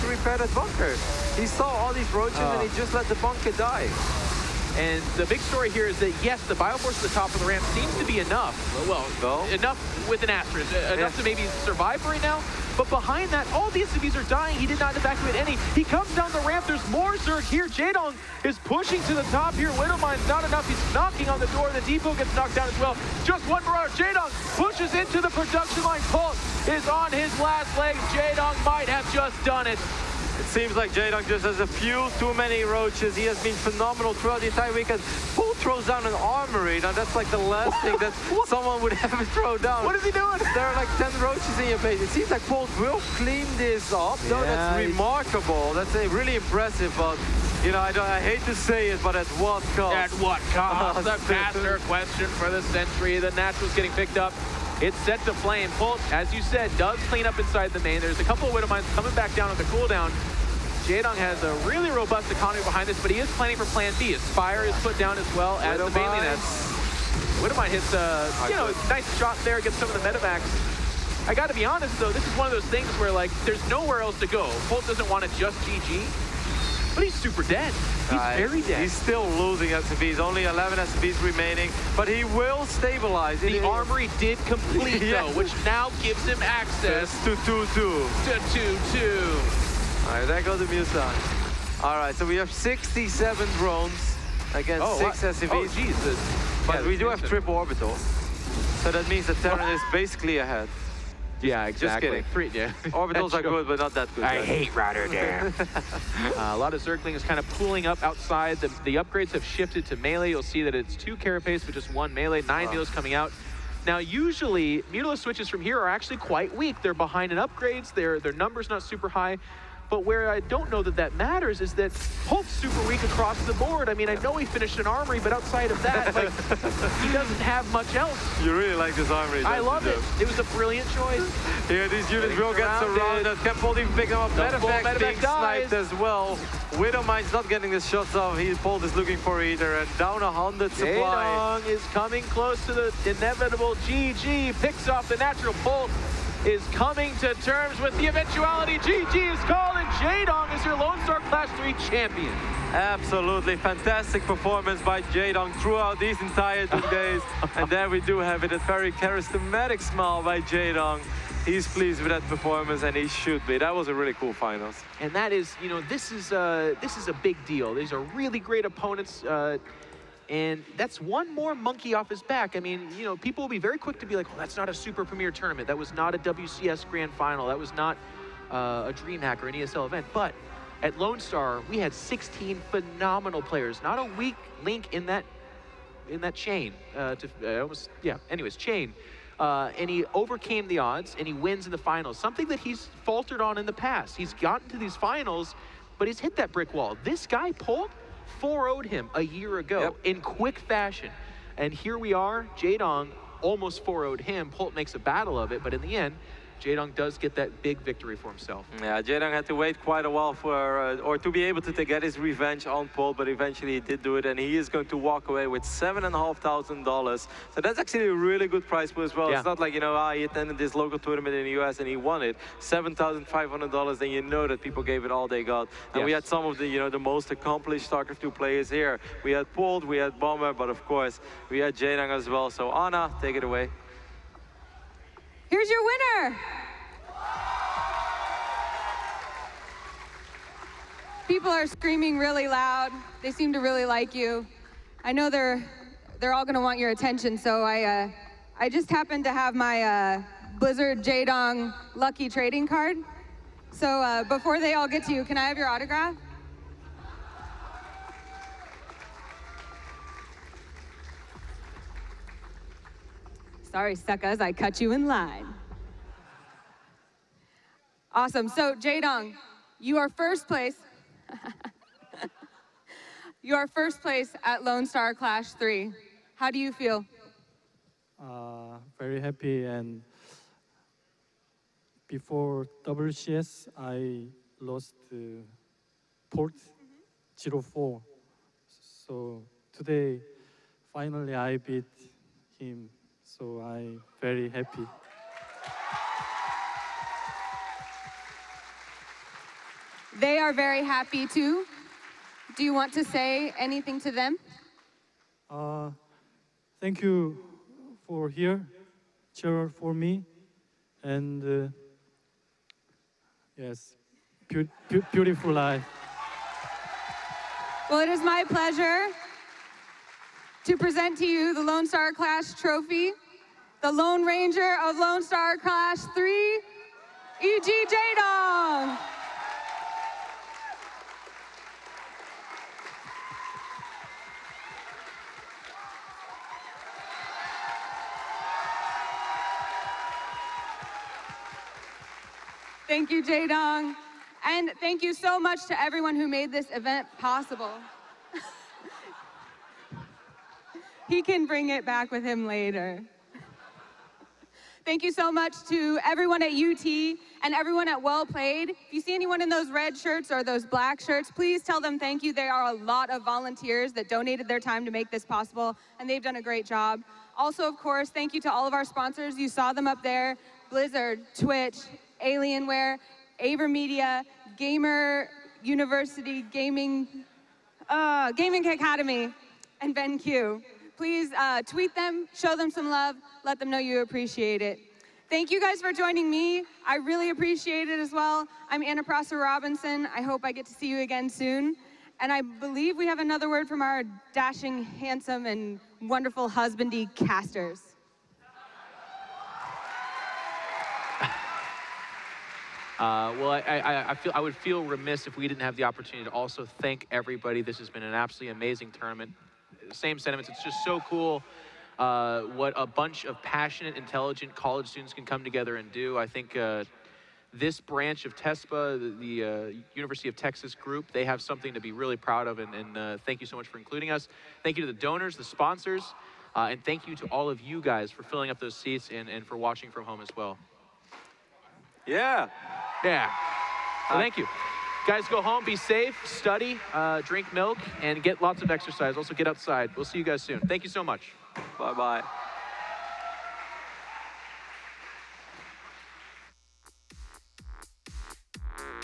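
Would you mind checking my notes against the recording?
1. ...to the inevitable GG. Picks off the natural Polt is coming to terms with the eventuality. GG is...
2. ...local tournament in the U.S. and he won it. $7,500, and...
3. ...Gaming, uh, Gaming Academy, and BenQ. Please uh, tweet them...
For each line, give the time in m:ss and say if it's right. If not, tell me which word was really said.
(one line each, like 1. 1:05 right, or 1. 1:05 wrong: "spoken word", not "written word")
1. 2:22 right
2. 3:40 right
3. 6:16 right.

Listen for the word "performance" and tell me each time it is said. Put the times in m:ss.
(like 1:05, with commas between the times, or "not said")
2:34, 2:42.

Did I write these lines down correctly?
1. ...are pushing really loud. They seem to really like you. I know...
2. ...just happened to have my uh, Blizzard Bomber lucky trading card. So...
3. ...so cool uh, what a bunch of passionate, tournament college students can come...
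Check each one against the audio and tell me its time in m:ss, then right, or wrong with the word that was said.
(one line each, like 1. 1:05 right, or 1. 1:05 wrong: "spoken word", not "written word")
1. 4:01 wrong: "screaming", not "pushing"
2. 4:08 wrong: "Jaedong", not "Bomber"
3. 6:50 wrong: "intelligent", not "tournament".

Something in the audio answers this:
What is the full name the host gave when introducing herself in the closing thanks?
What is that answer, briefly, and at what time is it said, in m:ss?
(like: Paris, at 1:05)
Anna Prosser Robinson, at 6:28.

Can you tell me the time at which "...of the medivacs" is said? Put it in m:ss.
1:09.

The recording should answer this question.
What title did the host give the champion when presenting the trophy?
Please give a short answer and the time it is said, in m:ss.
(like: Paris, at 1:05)
Lone Ranger, at 5:23.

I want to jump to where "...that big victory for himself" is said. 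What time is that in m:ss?
3:27.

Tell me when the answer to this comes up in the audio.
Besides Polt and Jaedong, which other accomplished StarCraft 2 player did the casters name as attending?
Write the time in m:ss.
3:49.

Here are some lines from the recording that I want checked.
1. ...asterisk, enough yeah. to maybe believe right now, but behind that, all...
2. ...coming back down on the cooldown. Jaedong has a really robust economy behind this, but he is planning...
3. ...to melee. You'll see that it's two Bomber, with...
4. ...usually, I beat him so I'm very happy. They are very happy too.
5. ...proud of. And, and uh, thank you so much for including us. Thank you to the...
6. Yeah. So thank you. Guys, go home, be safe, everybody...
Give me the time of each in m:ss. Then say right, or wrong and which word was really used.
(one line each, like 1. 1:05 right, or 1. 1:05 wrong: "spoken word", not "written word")
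1. 0:10 wrong: "survive", not "believe"
2. 0:58 right
3. 1:49 wrong: "Carapace", not "Bomber"
4. 4:50 wrong: "finally", not "usually"
5. 7:02 right
6. 7:13 wrong: "study", not "everybody".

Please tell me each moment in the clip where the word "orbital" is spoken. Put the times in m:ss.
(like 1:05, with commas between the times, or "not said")
1:37, 1:42.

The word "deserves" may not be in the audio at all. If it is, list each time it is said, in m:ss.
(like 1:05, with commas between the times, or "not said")
not said.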